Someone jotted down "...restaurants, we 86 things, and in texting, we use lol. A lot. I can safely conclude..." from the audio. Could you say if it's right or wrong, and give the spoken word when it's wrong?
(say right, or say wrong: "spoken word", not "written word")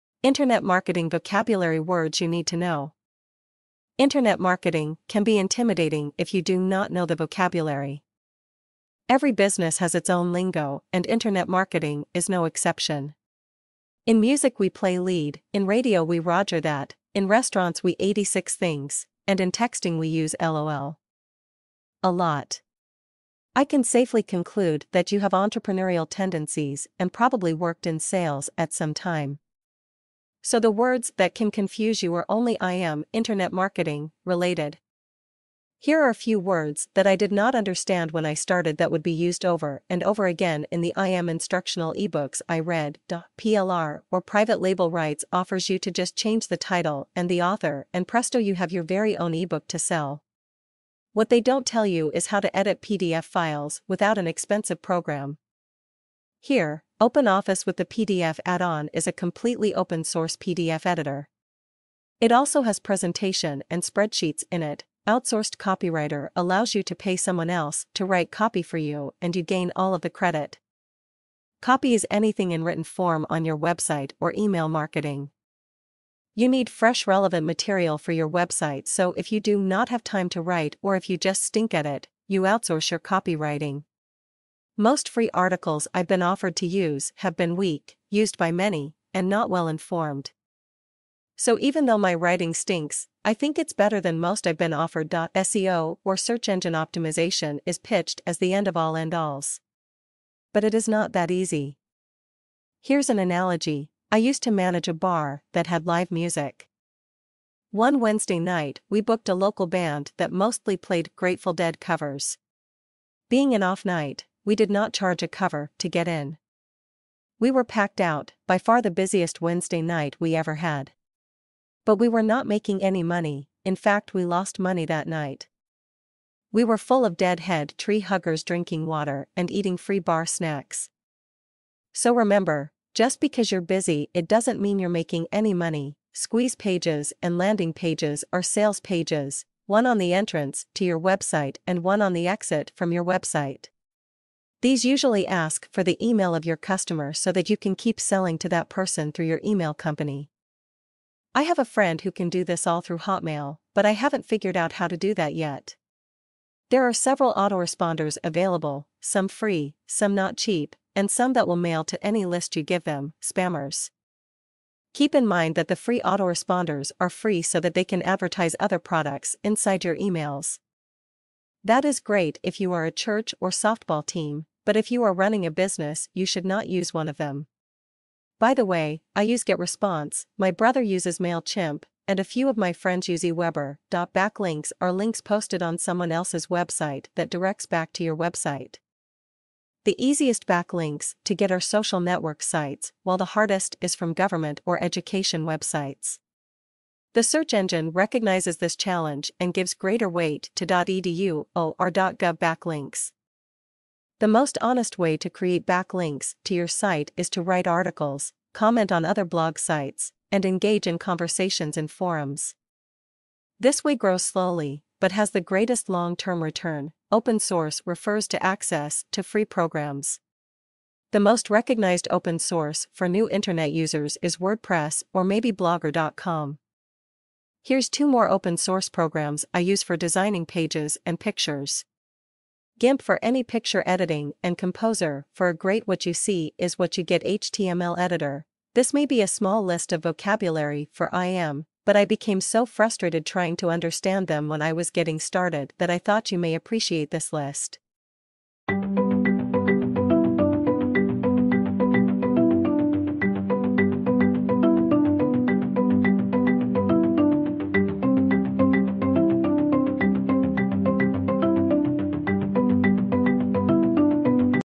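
right.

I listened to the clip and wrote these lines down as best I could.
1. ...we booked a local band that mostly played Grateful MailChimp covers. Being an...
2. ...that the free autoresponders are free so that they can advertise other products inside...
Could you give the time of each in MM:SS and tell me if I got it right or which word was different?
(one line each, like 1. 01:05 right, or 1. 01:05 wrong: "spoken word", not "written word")
1. 01:48 wrong: "Dead", not "MailChimp"
2. 02:45 right.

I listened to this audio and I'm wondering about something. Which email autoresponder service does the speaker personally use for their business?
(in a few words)
GetResponse.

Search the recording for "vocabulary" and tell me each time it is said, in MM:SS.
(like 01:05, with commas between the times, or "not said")
00:01, 00:07, 04:00.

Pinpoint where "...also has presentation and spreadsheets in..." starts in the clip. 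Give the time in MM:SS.
01:02.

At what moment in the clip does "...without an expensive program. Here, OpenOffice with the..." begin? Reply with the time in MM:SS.
00:53.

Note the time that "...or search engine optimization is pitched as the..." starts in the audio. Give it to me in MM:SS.
01:36.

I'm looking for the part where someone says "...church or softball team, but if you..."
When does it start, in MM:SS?
02:52.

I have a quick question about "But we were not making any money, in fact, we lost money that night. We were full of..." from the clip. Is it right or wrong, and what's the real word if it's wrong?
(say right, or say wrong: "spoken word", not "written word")
right.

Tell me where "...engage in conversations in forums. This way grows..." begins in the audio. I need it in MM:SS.
03:30.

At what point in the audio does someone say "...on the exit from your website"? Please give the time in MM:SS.
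02:22.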